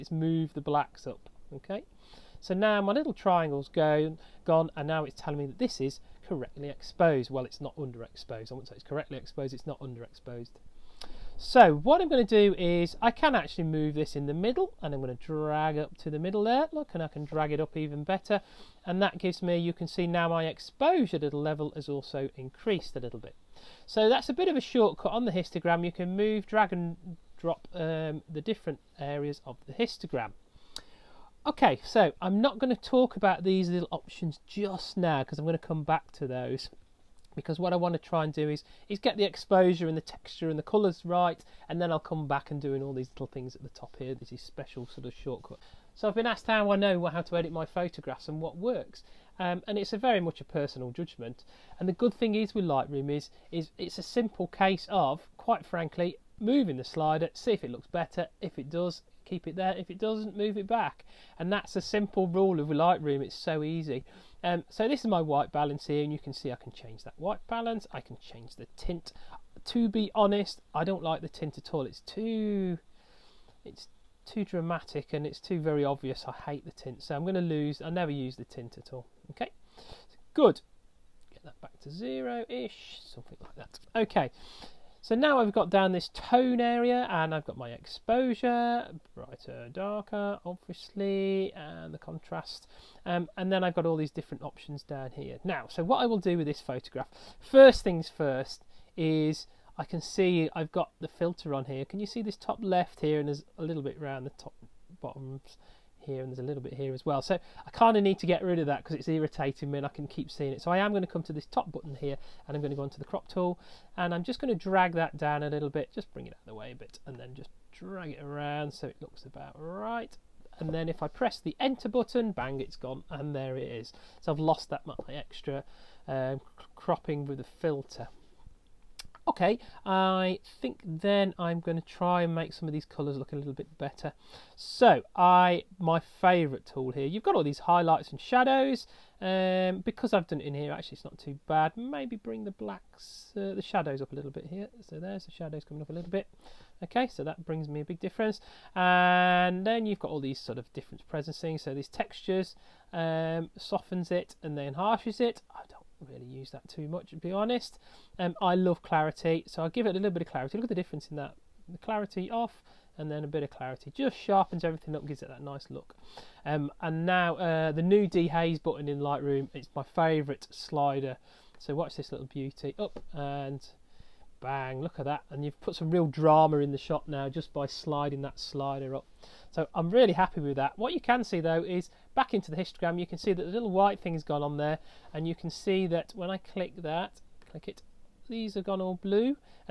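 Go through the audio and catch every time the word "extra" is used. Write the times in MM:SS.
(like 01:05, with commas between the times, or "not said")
02:05.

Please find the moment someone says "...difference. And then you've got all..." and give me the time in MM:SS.
02:27.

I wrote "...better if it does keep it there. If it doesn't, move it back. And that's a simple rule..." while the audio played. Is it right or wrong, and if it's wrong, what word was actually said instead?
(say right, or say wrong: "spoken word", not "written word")
right.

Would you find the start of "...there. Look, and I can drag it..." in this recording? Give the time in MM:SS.
00:16.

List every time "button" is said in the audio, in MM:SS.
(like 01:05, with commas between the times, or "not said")
01:51, 02:01, 02:48.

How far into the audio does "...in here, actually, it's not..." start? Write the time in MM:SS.
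02:20.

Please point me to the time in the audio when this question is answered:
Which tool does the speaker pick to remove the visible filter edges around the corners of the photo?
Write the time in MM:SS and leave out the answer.
01:53.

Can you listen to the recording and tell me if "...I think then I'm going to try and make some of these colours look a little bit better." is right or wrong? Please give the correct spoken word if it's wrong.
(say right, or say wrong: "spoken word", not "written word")
right.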